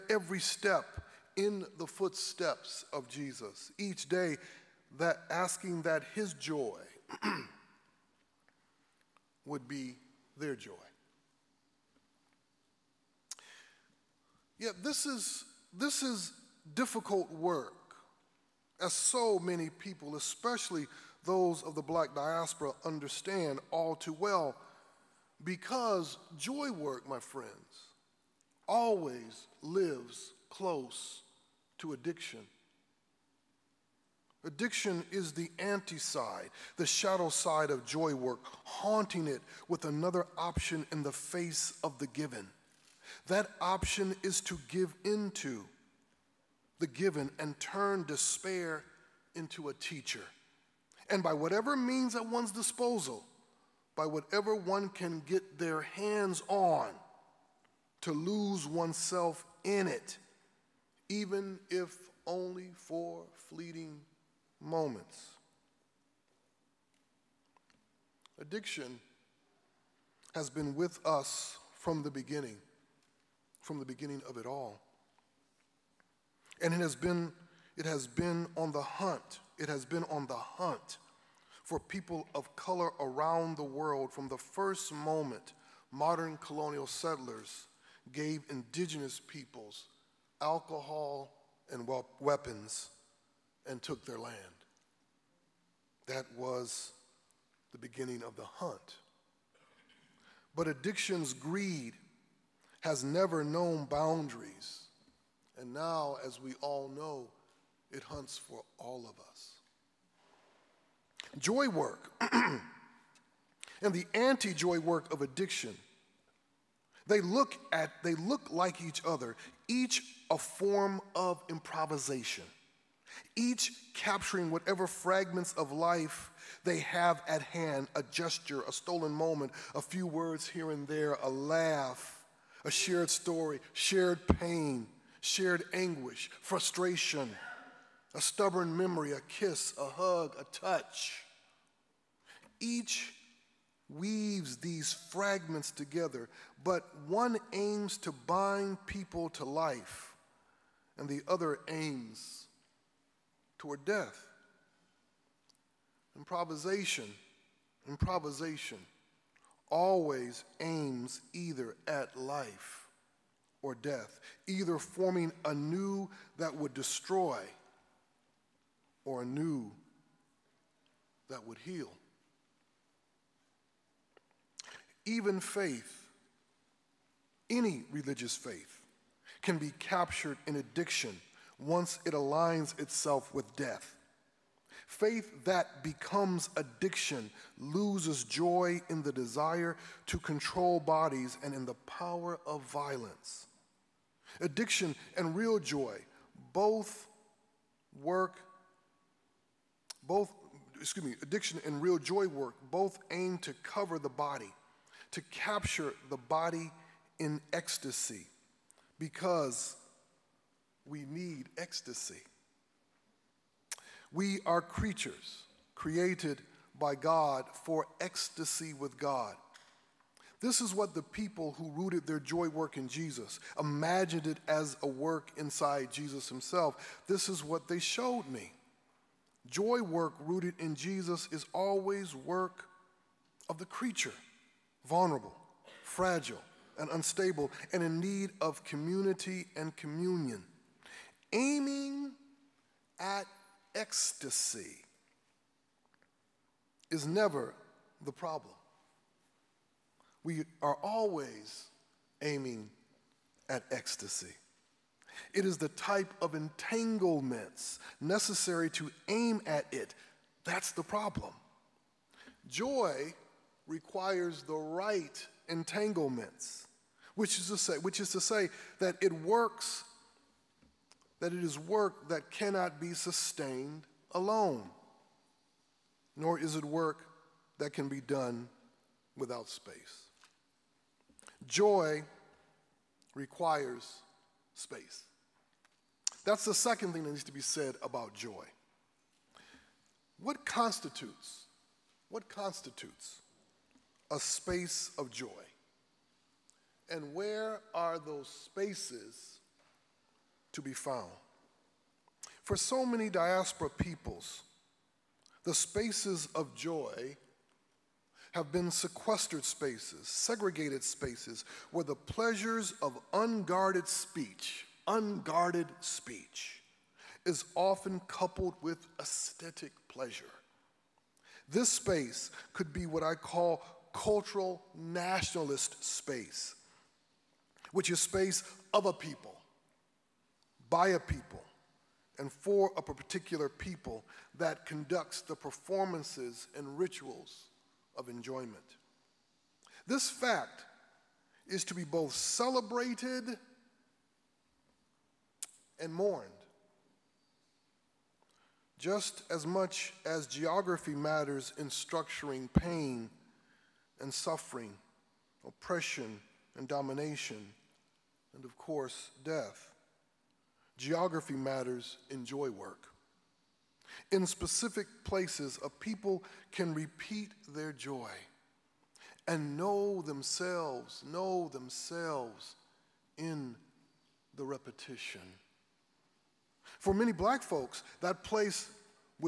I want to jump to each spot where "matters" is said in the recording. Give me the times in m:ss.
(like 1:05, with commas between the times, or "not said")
5:50, 6:01.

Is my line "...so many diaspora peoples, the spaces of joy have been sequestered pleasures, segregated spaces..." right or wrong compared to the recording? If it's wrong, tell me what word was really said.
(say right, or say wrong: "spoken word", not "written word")
wrong: "spaces", not "pleasures".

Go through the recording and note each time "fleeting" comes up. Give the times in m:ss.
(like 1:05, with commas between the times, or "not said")
1:03.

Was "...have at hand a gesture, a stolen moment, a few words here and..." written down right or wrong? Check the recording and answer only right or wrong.
right.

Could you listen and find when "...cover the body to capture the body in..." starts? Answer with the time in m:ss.
3:23.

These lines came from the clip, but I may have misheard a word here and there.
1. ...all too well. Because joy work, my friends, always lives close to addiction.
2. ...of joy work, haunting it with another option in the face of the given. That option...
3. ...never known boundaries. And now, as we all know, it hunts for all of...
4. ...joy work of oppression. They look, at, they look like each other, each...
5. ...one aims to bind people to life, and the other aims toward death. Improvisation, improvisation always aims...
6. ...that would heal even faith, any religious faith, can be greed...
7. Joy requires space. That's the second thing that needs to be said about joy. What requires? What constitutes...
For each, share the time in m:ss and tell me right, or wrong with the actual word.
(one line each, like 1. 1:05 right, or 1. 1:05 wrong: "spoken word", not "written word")
1. 0:23 right
2. 0:37 right
3. 1:43 right
4. 1:54 wrong: "addiction", not "oppression"
5. 2:27 right
6. 2:51 wrong: "captured", not "greed"
7. 4:41 wrong: "constitutes", not "requires".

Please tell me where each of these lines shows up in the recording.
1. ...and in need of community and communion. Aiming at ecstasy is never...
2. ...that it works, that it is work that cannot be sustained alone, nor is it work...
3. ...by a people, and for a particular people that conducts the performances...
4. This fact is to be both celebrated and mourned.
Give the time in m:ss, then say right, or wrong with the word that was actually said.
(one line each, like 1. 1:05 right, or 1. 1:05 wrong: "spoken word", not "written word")
1. 3:57 right
2. 4:28 right
3. 5:30 right
4. 5:39 right.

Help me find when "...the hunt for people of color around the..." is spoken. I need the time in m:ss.
1:20.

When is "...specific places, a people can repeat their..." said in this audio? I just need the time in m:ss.
6:04.